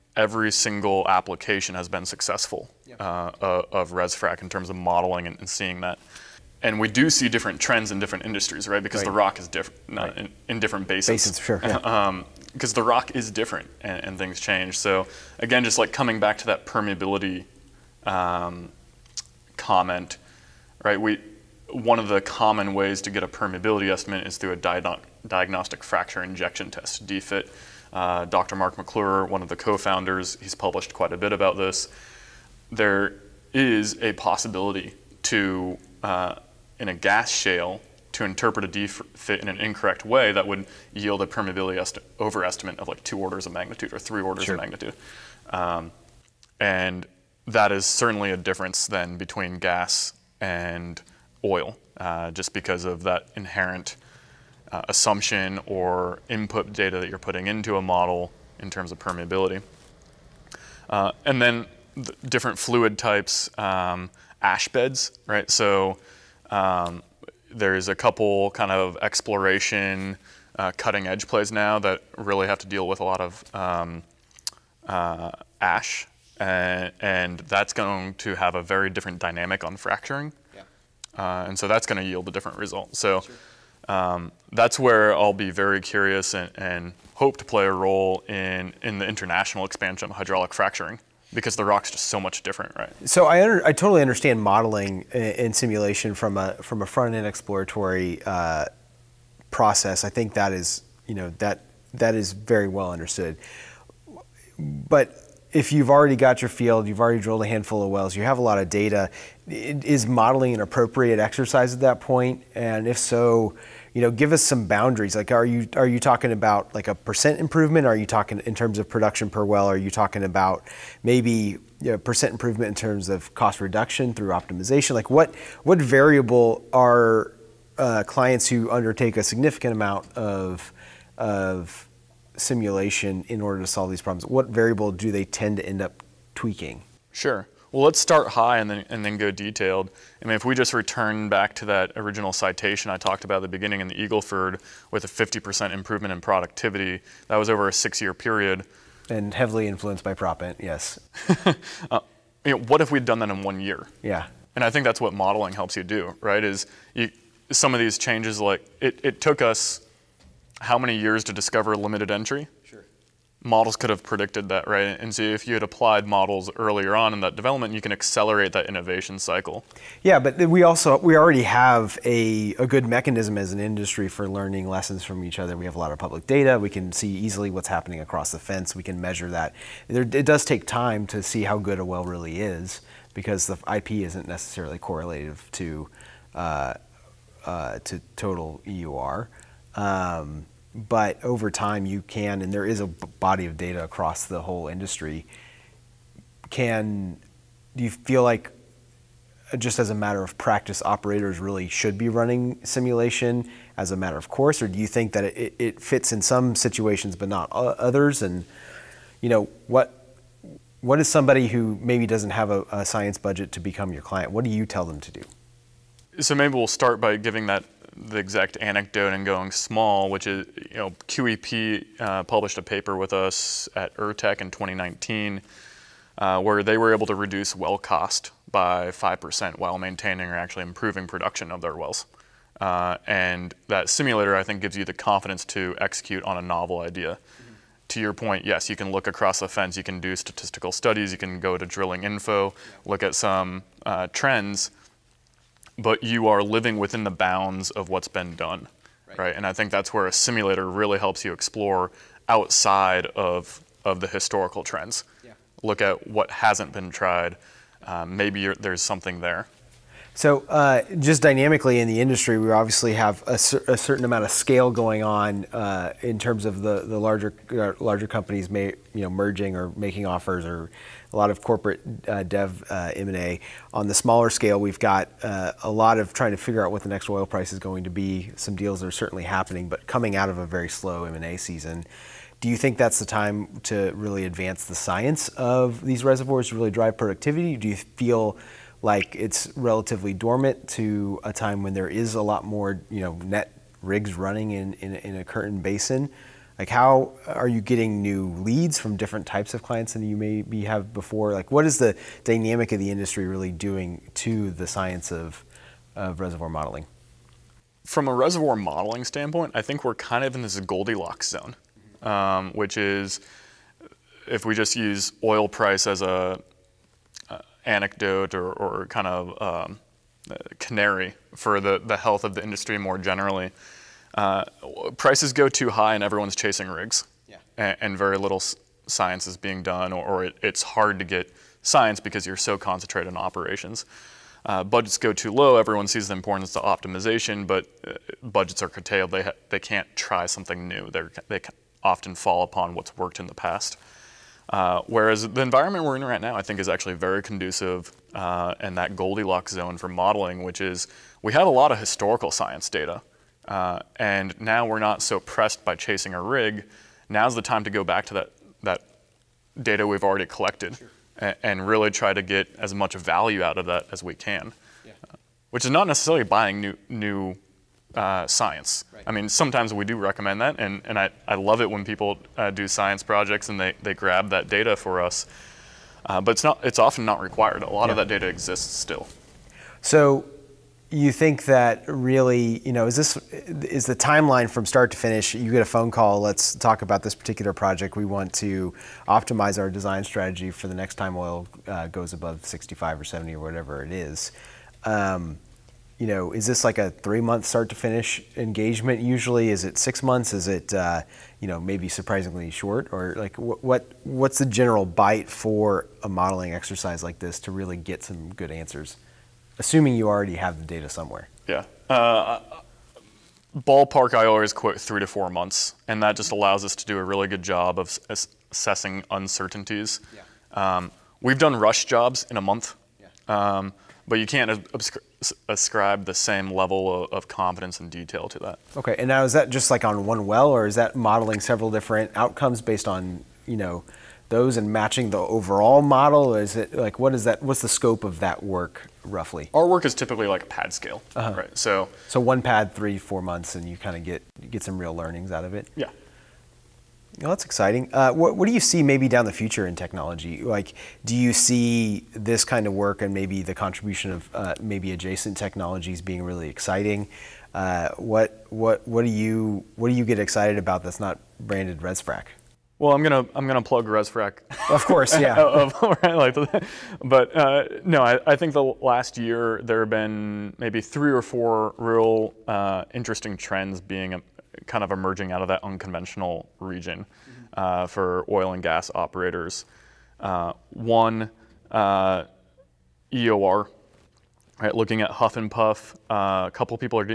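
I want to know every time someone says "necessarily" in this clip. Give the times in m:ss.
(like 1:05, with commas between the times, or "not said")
3:04, 6:05.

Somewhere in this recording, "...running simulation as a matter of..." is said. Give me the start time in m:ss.
3:22.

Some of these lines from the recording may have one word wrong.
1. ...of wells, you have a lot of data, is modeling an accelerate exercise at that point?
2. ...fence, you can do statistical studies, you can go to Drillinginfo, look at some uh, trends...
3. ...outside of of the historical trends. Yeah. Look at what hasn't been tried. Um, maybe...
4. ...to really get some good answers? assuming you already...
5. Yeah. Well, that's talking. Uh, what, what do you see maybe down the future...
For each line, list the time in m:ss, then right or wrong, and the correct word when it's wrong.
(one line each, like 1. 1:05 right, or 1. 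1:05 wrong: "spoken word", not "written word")
1. 1:47 wrong: "appropriate", not "accelerate"
2. 3:59 right
3. 4:12 right
4. 6:47 right
5. 7:25 wrong: "exciting", not "talking".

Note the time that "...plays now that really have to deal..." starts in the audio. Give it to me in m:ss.
1:11.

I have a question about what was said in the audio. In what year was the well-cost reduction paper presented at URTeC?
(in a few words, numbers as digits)
2019.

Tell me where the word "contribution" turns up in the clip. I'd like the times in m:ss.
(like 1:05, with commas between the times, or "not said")
7:33.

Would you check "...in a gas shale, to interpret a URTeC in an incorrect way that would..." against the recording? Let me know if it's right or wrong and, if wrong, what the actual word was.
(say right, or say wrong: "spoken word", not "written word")
wrong: "DFIT", not "URTeC".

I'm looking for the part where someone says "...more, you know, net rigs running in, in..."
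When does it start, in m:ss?
4:52.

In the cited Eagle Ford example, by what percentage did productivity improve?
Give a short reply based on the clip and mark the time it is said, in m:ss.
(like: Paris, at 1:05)
50%, at 2:25.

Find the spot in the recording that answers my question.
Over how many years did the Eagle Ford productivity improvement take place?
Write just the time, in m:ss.
2:27.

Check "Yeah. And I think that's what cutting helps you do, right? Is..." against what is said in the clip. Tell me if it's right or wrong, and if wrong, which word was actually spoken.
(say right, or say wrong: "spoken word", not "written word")
wrong: "modeling", not "cutting".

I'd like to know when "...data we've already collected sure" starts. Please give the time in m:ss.
5:59.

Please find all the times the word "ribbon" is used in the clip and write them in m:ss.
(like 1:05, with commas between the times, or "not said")
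not said.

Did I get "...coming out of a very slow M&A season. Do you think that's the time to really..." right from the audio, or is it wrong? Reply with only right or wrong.
right.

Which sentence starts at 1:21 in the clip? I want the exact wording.
Uh, and so that's going to yield a different result.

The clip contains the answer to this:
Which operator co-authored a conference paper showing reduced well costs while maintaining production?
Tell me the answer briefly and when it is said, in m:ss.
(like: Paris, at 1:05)
QEP, at 3:41.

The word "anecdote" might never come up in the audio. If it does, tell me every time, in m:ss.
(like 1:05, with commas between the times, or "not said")
3:38, 5:17.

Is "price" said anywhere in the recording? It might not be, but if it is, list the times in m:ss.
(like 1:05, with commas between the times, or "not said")
4:37, 5:15, 5:24.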